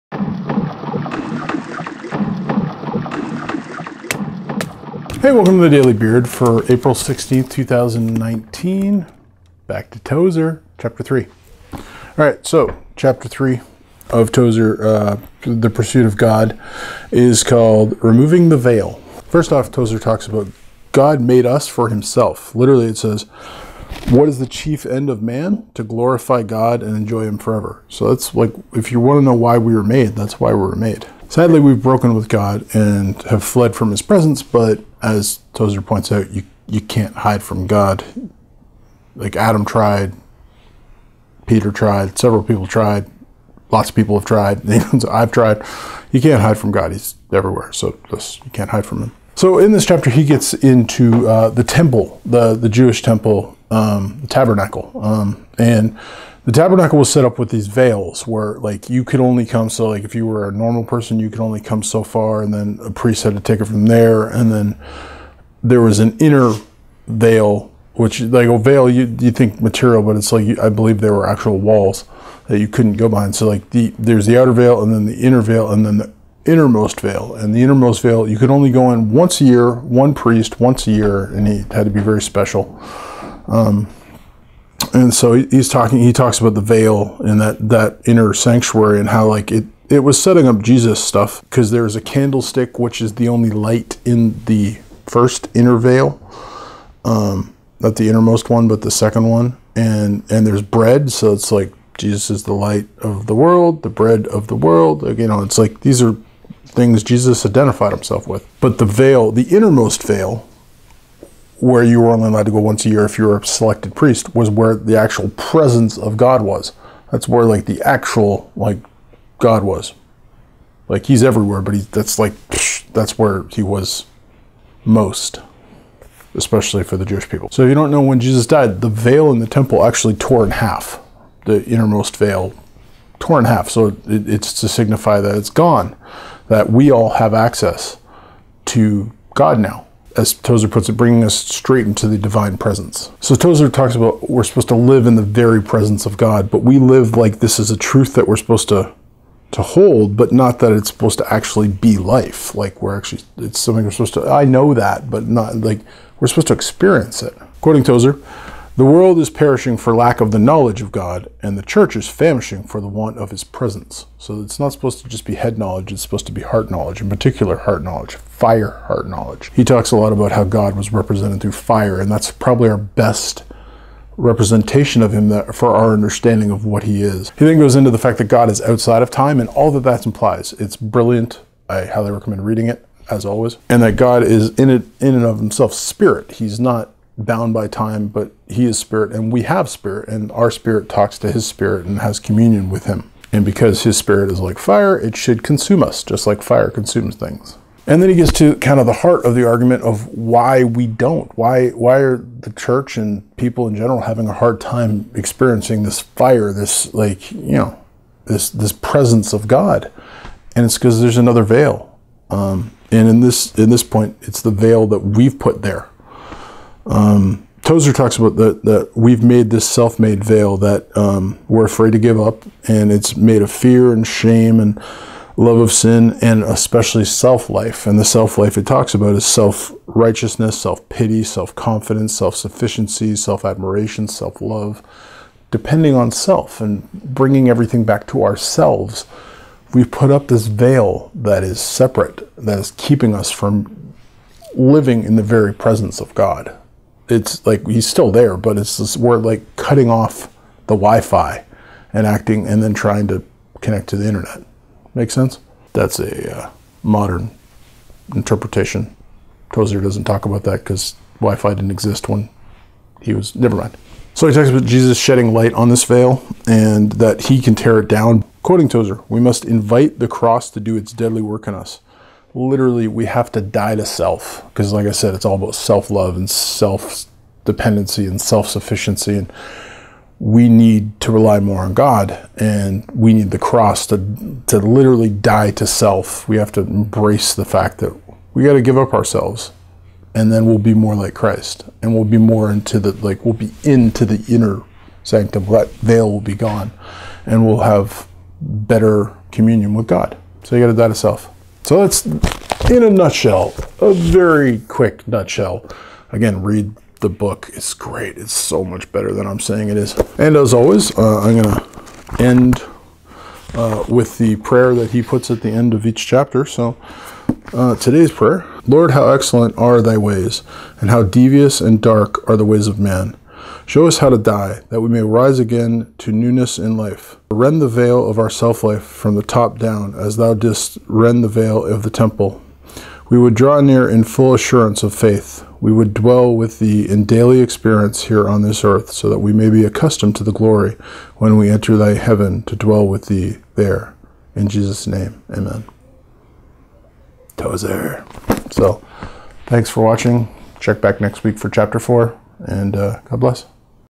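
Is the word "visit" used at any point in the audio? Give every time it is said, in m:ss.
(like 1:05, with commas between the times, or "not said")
not said.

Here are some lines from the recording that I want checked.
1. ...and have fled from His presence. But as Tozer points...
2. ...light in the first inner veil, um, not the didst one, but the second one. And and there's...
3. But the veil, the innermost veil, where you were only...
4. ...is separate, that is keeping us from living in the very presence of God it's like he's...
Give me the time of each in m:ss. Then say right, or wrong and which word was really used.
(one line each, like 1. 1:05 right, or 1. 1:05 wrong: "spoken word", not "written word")
1. 0:32 right
2. 1:33 wrong: "innermost", not "didst"
3. 1:48 right
4. 4:01 right.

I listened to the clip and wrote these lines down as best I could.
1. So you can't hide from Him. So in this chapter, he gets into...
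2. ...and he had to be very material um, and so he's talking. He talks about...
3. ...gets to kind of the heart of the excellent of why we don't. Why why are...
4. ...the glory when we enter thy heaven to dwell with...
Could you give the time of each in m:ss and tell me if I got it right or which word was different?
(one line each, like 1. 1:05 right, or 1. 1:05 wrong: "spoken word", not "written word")
1. 0:47 right
2. 1:21 wrong: "special", not "material"
3. 3:18 wrong: "argument", not "excellent"
4. 5:40 right.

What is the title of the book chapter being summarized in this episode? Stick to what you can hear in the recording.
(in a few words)
Removing the Veil.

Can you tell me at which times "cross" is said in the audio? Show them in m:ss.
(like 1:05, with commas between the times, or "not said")
4:30, 4:43.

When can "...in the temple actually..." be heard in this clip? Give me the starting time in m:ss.
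2:09.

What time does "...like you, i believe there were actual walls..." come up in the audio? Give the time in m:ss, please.
1:10.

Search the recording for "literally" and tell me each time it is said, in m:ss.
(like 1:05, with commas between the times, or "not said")
0:22, 4:32, 4:44.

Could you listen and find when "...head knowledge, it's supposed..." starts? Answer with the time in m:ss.
2:45.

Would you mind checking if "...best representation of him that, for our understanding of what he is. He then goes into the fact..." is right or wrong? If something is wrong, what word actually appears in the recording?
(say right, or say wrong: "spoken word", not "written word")
right.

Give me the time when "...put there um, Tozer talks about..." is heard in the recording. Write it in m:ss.
3:35.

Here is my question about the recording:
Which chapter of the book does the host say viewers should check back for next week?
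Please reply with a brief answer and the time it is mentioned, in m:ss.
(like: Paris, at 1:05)
Chapter 4, at 5:51.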